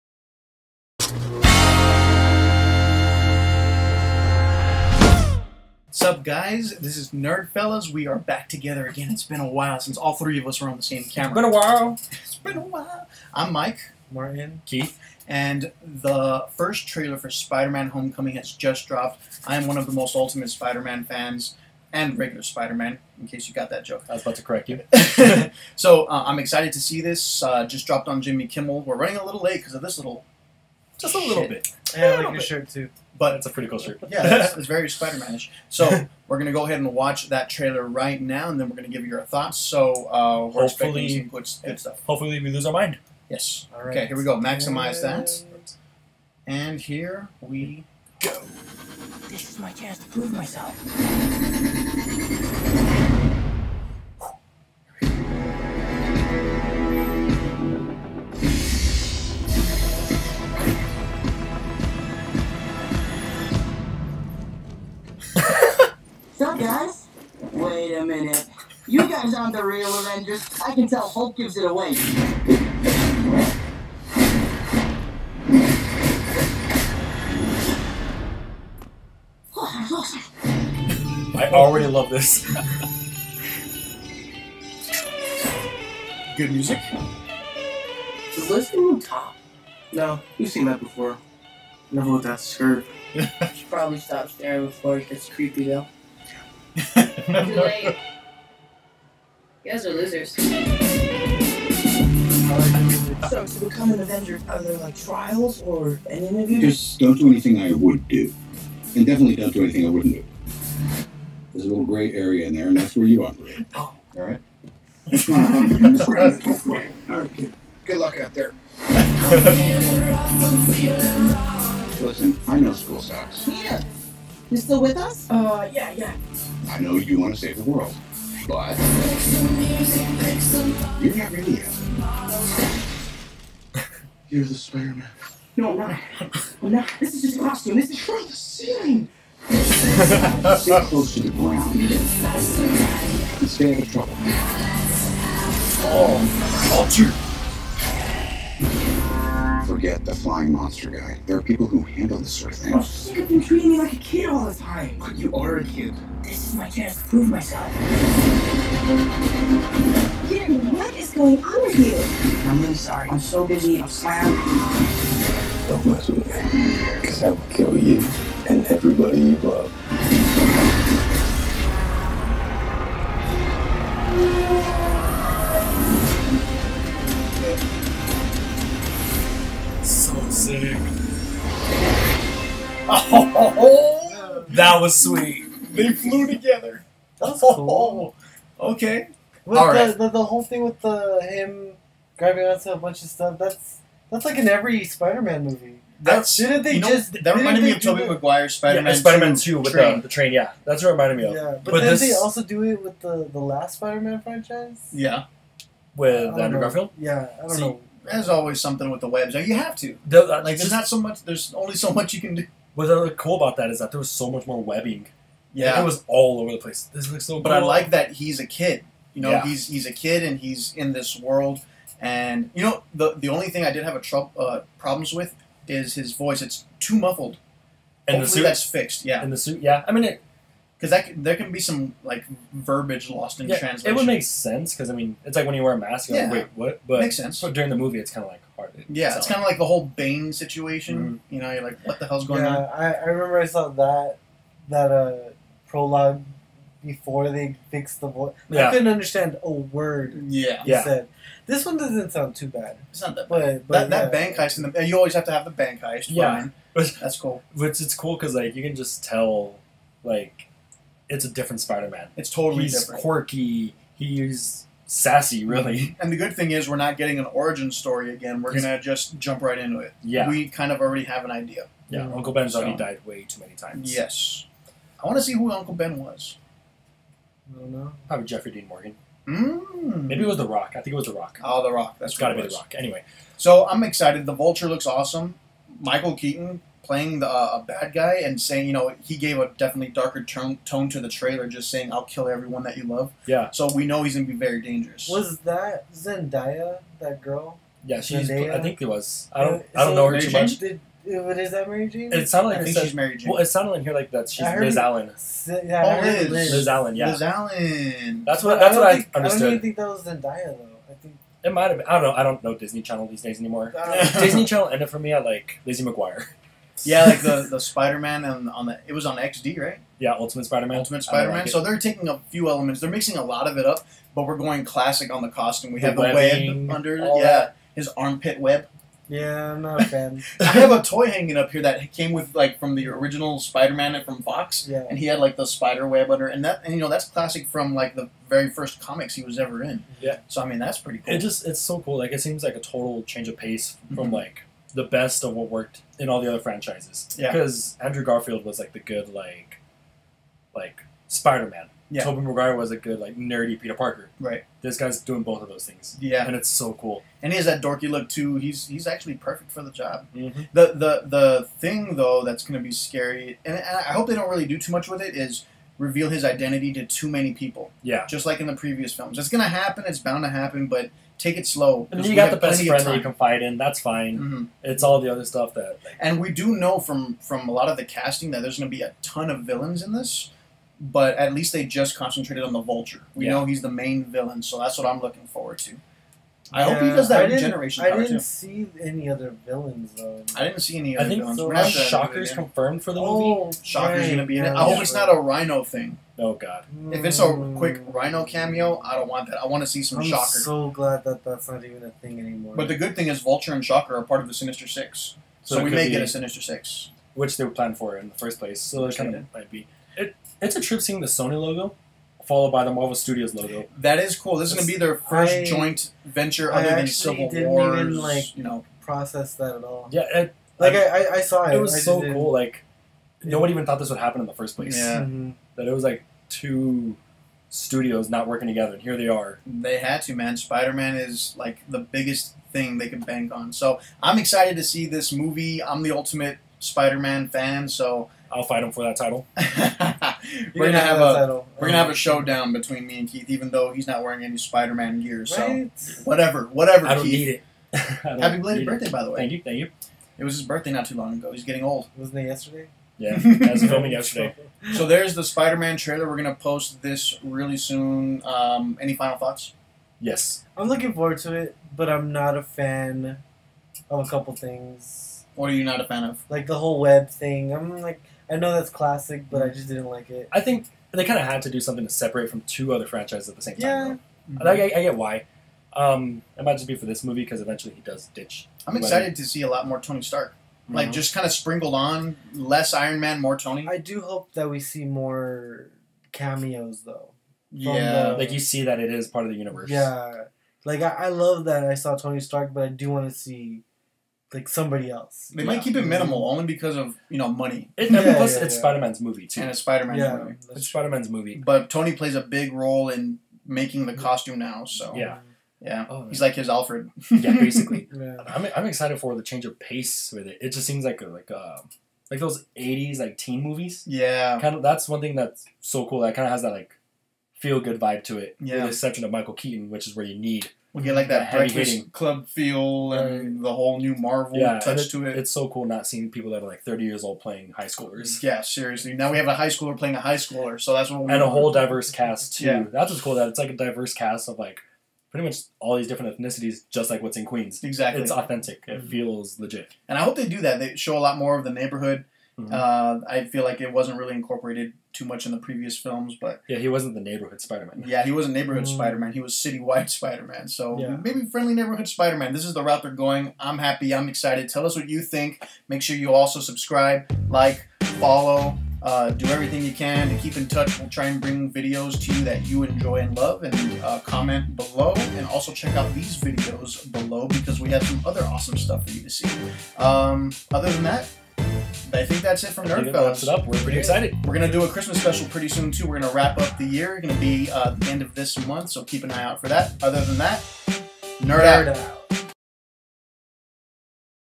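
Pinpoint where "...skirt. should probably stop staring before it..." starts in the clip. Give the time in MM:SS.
01:32.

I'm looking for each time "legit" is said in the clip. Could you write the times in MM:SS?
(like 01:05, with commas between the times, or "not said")
08:59.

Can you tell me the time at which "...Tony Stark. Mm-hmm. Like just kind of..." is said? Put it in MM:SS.
07:59.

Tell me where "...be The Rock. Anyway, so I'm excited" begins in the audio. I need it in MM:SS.
04:42.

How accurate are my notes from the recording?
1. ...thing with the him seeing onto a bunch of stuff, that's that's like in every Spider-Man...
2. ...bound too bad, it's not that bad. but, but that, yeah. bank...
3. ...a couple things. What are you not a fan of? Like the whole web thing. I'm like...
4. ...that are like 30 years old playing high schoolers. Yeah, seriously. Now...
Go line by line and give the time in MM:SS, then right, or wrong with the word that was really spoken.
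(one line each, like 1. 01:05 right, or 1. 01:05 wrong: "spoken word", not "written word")
1. 03:10 wrong: "grabbing", not "seeing"
2. 04:12 wrong: "sound", not "bound"
3. 07:44 right
4. 08:46 right.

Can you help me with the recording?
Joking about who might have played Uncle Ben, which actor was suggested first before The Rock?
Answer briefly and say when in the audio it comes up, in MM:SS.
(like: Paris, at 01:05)
Jeffrey Dean Morgan, at 04:38.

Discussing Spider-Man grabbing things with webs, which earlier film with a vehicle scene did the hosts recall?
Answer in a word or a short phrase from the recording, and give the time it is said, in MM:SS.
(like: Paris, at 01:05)
Spider-Man Two, at 03:18.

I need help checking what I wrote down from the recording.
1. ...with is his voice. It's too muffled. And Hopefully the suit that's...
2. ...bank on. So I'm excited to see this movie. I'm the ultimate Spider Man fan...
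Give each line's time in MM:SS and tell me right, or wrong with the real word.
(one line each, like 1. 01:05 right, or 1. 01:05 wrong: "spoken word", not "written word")
1. 03:45 right
2. 07:13 right.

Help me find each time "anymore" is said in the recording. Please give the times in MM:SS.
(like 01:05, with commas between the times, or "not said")
05:13, 06:42.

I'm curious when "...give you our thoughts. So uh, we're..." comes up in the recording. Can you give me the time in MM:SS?
00:38.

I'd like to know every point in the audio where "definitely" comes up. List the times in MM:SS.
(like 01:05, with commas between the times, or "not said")
01:49, 04:49.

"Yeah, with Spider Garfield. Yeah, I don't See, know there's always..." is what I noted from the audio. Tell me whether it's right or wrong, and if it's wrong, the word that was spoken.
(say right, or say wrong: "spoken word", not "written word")
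wrong: "Andrew", not "Spider".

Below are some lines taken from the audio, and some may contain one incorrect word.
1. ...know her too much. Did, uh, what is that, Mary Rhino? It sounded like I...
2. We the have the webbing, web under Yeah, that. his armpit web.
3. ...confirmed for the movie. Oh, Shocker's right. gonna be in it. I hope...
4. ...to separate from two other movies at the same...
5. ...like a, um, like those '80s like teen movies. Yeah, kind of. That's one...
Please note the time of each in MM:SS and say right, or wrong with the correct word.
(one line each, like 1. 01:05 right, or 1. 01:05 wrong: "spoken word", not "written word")
1. 04:59 wrong: "Jane", not "Rhino"
2. 05:25 right
3. 06:32 right
4. 07:51 wrong: "franchises", not "movies"
5. 08:31 right.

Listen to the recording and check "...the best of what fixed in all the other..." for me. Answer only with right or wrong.
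wrong.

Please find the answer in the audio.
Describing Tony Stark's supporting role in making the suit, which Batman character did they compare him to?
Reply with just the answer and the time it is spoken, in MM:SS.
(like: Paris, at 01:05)
Alfred, at 08:26.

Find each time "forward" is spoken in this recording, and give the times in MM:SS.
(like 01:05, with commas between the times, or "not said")
06:25, 07:40.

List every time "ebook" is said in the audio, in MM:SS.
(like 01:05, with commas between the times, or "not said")
not said.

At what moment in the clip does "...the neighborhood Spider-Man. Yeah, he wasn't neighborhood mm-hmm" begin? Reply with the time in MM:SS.
09:06.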